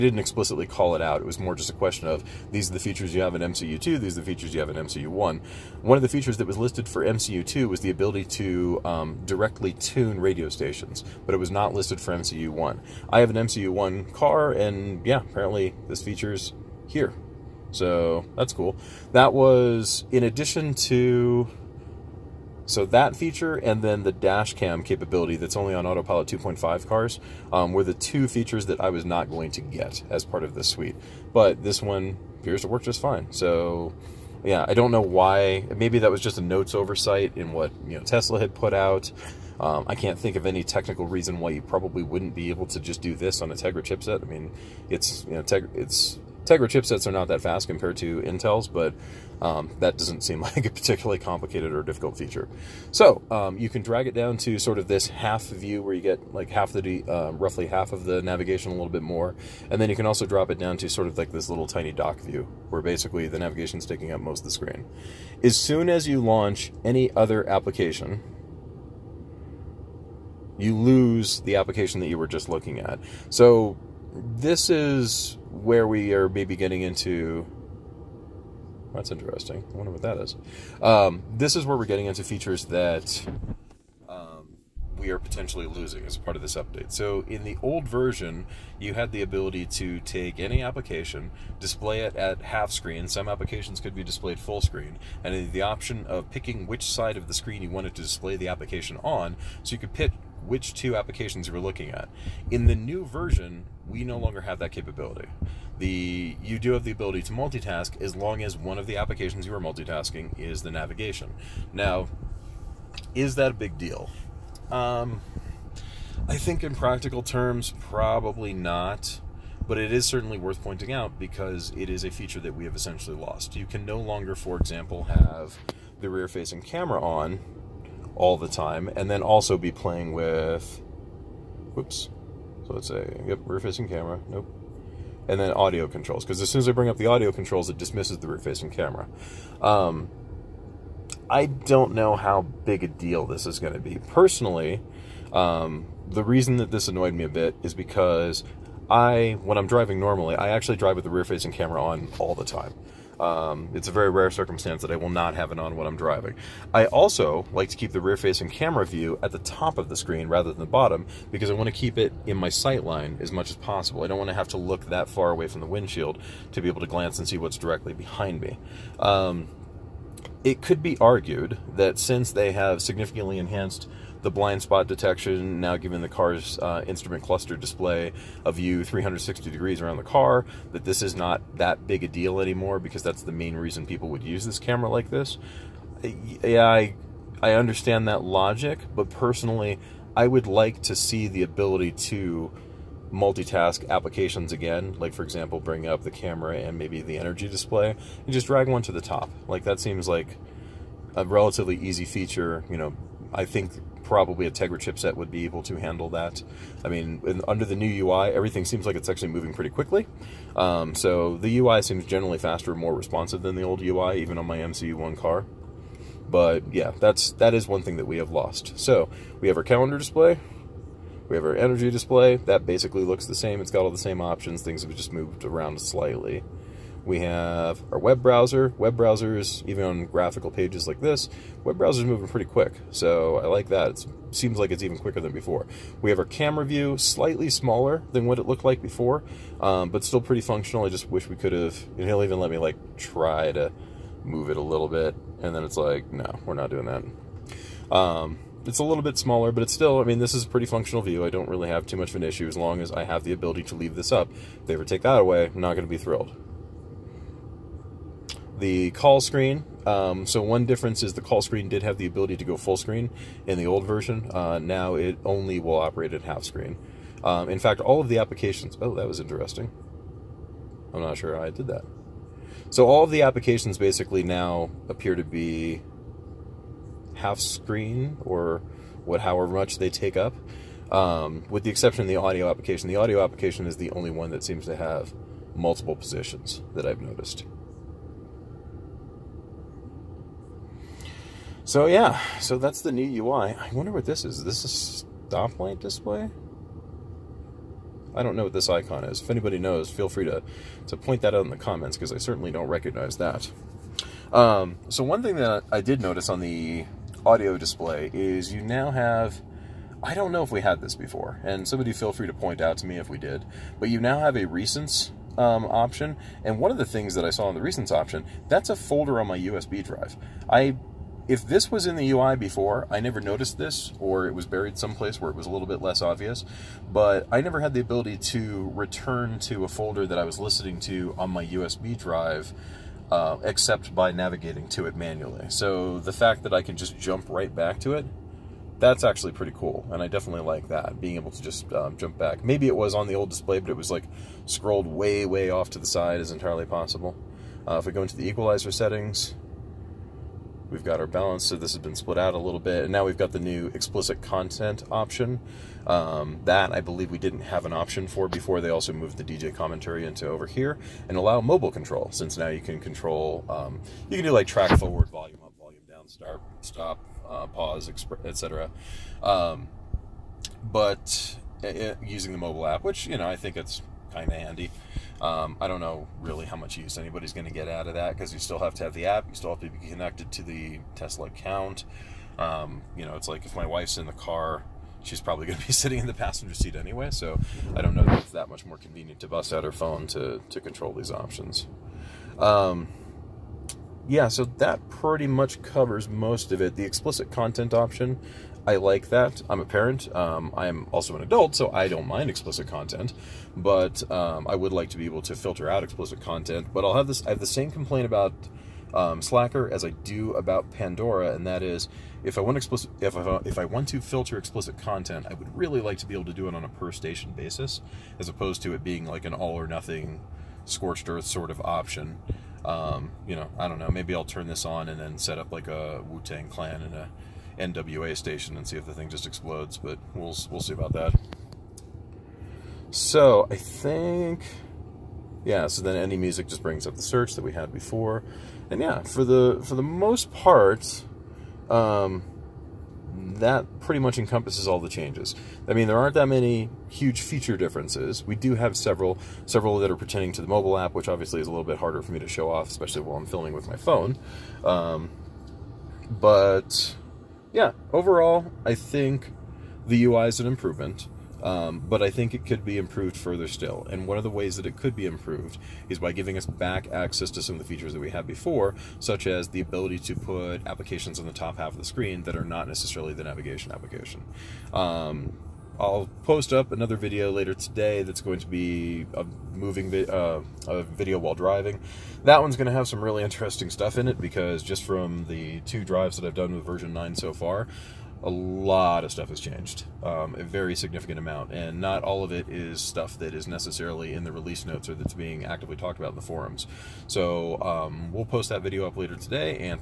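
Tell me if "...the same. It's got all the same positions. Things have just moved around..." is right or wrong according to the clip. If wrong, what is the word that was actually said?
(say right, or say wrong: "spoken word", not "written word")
wrong: "options", not "positions".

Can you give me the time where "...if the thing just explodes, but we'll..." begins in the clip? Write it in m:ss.
7:08.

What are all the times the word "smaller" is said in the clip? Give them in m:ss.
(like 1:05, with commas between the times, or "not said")
3:57, 4:09.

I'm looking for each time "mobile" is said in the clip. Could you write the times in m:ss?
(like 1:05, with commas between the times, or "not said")
6:01, 6:12, 7:30.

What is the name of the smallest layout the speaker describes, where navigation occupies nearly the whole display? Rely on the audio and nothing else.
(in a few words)
dock view.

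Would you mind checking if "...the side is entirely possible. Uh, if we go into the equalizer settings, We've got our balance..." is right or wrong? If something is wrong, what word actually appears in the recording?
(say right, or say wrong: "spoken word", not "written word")
right.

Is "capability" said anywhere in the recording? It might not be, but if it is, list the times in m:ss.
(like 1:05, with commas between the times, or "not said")
0:24, 1:44.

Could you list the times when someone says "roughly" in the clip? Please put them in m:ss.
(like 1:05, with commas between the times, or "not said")
0:57.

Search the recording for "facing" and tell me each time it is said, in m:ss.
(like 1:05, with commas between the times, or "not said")
2:06, 2:13, 2:18, 2:31, 2:37.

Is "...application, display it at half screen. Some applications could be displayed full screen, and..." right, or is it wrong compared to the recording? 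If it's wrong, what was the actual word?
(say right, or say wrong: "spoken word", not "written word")
right.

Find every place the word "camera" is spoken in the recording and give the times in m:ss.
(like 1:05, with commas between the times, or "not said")
2:06, 2:13, 2:18, 2:31, 2:38, 3:04, 3:16, 3:56.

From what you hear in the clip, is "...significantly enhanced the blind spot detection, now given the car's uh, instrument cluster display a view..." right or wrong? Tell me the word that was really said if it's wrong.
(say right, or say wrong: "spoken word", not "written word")
right.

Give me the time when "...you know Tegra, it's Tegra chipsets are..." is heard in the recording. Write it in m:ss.
0:45.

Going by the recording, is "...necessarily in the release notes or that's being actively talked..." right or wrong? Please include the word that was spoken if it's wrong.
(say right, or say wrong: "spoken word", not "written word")
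right.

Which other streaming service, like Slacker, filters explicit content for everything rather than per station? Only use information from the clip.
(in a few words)
Pandora.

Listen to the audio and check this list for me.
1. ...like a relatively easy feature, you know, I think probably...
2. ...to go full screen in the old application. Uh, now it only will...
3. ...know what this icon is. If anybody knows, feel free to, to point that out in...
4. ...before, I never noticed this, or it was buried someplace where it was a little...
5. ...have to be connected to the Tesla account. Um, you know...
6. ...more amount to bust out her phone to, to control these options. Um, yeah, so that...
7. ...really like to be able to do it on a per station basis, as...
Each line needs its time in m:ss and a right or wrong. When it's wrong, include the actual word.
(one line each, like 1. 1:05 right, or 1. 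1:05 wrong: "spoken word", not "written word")
1. 3:20 right
2. 4:22 wrong: "version", not "application"
3. 4:58 right
4. 5:22 right
5. 6:19 right
6. 6:28 wrong: "convenient", not "amount"
7. 6:55 right.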